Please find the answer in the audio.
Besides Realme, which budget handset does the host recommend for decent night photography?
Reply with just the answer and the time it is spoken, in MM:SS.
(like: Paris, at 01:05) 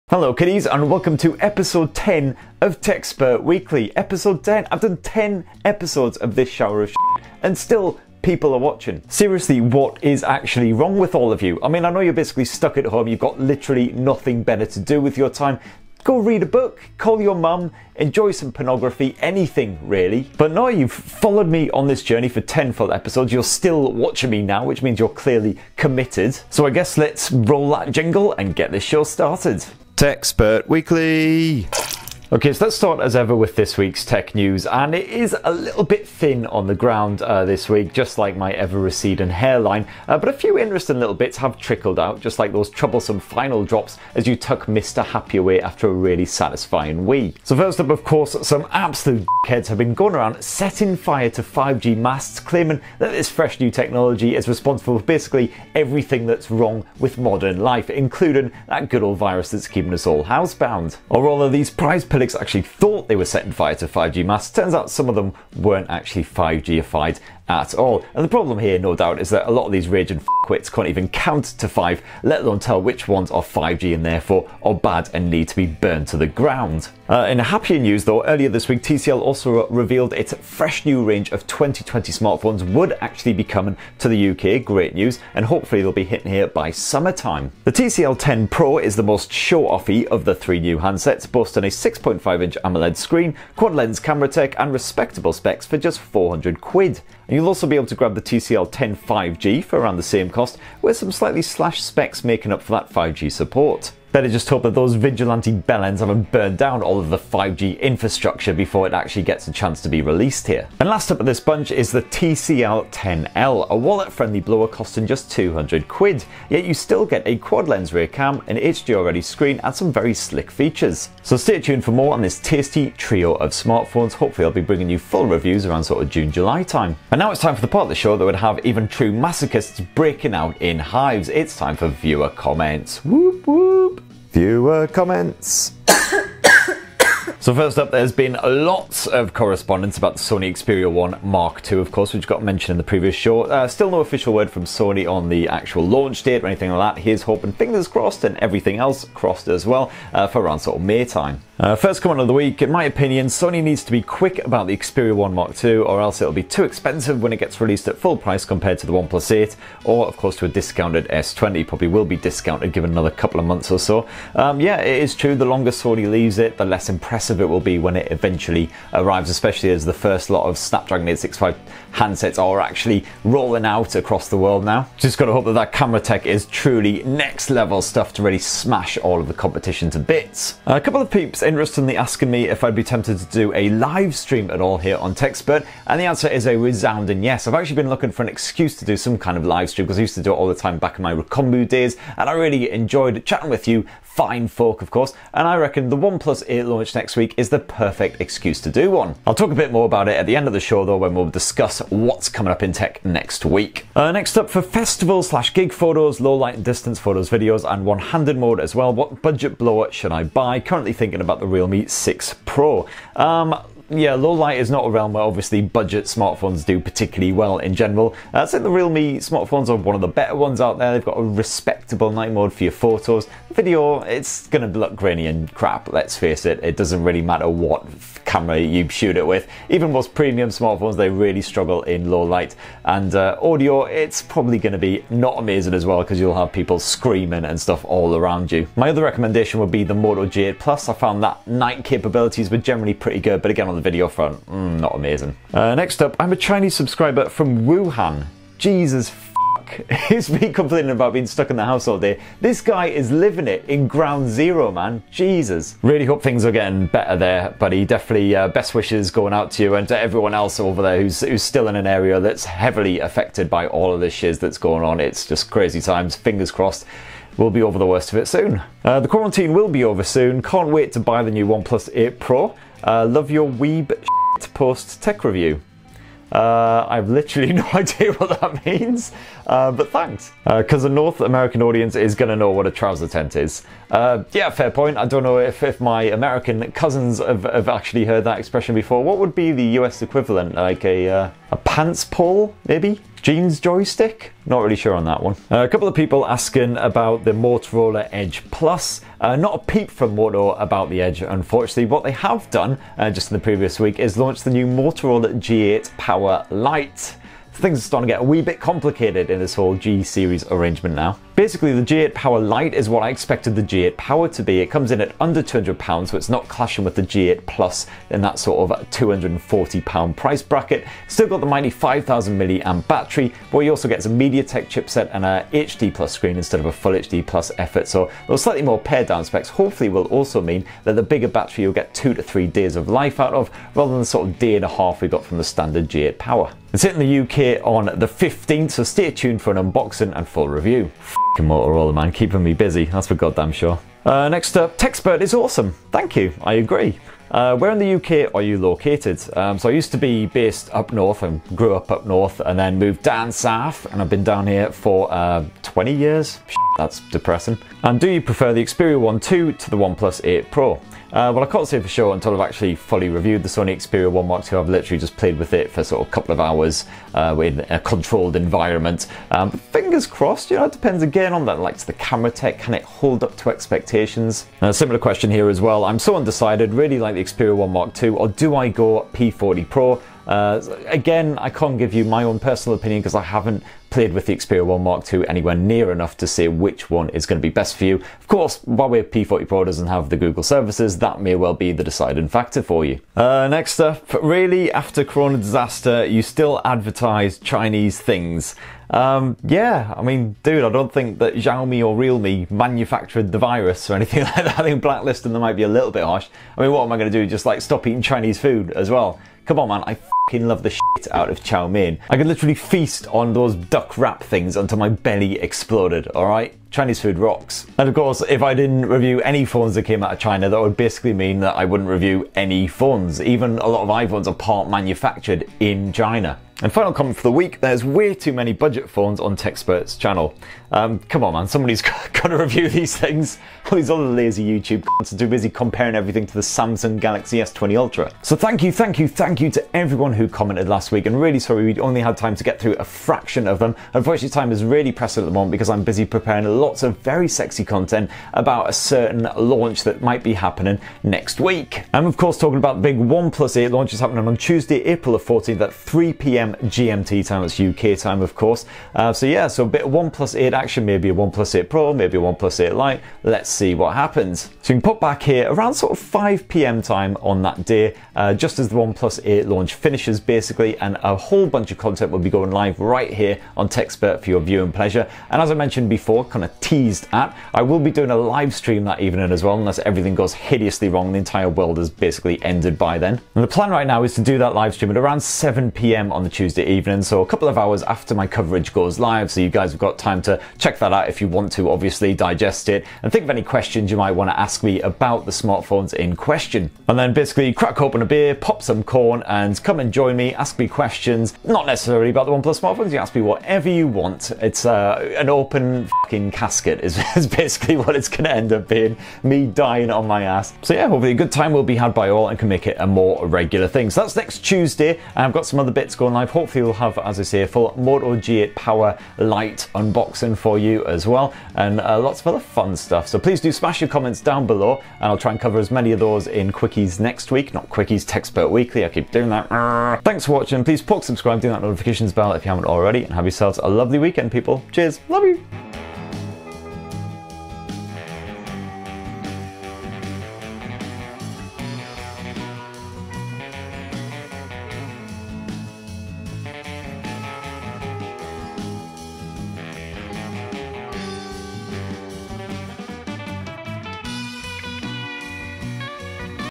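Moto G8 Plus, at 03:59.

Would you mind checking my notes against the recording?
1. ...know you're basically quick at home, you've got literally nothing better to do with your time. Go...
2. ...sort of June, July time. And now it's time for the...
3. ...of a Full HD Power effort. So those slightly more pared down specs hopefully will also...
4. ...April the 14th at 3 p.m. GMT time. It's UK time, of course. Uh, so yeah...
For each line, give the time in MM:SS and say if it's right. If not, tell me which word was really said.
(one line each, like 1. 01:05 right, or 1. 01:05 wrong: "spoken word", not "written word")
1. 00:11 wrong: "stuck", not "quick"
2. 02:05 right
3. 05:26 wrong: "Plus", not "Power"
4. 07:34 right.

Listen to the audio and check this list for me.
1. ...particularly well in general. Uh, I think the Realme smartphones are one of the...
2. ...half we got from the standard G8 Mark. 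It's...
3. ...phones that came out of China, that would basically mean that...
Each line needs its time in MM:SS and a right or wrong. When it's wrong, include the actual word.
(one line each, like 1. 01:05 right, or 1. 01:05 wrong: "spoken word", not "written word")
1. 03:36 right
2. 05:34 wrong: "Power", not "Mark"
3. 06:59 right.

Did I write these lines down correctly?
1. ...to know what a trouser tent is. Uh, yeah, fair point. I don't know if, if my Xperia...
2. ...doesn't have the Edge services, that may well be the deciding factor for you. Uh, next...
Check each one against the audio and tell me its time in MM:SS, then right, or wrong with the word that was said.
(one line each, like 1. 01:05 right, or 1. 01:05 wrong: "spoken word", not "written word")
1. 04:42 wrong: "American", not "Xperia"
2. 06:29 wrong: "Google", not "Edge".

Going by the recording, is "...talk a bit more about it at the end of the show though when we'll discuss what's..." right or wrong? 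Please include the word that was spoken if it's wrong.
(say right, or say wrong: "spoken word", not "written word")
right.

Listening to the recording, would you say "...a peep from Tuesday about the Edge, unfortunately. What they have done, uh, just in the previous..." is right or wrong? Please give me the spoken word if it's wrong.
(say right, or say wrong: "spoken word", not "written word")
wrong: "Motorola", not "Tuesday".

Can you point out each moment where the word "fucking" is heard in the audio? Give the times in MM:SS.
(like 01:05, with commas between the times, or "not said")
06:49, 08:26.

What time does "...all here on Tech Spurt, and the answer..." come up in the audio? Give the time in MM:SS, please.
03:04.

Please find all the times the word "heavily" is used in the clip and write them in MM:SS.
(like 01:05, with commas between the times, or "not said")
04:22.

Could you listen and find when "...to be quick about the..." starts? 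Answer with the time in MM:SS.
02:33.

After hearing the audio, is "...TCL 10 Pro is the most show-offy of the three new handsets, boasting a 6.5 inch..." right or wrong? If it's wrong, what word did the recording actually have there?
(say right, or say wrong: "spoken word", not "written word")
right.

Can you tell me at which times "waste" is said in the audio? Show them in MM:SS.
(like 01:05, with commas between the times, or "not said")
not said.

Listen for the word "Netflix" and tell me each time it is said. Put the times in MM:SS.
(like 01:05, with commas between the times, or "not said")
not said.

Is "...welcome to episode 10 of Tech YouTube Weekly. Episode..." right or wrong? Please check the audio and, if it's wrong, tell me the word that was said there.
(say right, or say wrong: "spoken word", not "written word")
wrong: "Spurt", not "YouTube".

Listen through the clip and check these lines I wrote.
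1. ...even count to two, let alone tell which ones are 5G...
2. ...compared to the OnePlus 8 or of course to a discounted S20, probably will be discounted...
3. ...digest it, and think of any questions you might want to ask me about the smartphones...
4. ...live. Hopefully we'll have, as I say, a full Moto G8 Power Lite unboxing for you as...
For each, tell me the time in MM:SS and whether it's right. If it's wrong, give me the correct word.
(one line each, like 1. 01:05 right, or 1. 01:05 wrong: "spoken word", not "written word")
1. 01:10 wrong: "five", not "two"
2. 02:38 right
3. 08:12 right
4. 08:36 right.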